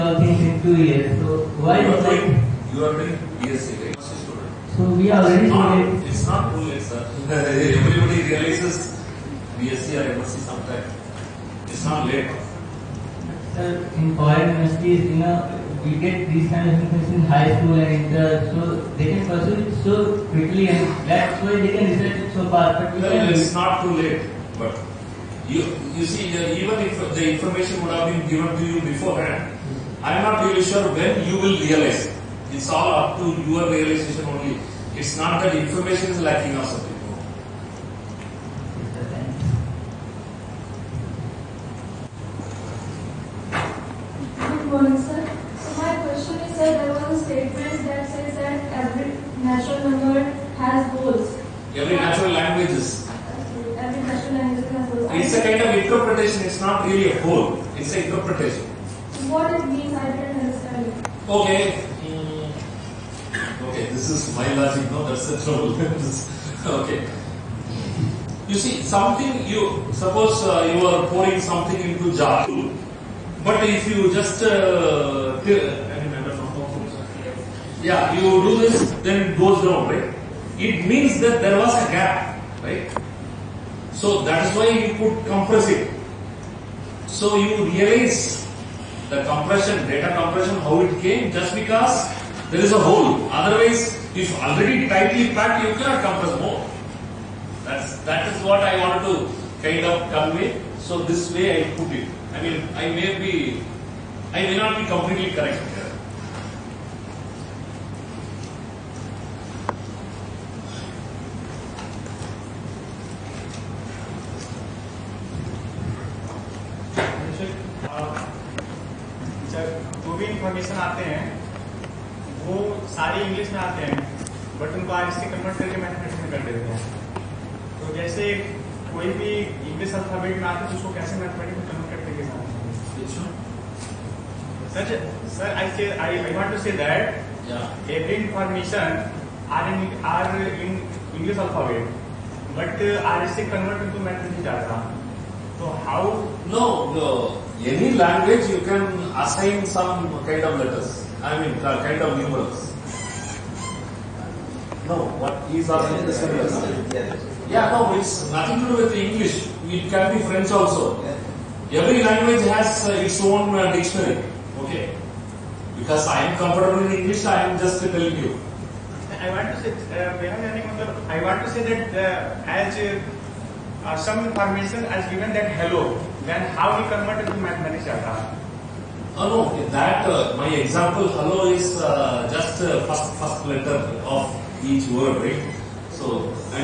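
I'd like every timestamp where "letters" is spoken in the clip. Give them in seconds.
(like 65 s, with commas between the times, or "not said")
150 s, 183 s.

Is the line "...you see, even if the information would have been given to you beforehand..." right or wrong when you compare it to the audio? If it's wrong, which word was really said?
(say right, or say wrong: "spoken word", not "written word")
right.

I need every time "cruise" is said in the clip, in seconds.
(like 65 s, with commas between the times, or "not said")
not said.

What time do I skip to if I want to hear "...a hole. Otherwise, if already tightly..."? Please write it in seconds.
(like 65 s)
92 s.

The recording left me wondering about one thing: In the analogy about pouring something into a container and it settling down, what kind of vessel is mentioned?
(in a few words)
jar.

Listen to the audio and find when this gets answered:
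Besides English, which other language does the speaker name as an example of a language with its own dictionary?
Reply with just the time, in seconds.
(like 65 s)
160 s.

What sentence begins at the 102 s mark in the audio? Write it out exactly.
I mean, I may be, I may not be completely correct.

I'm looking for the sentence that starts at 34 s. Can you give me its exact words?
It's not that information is lacking or something.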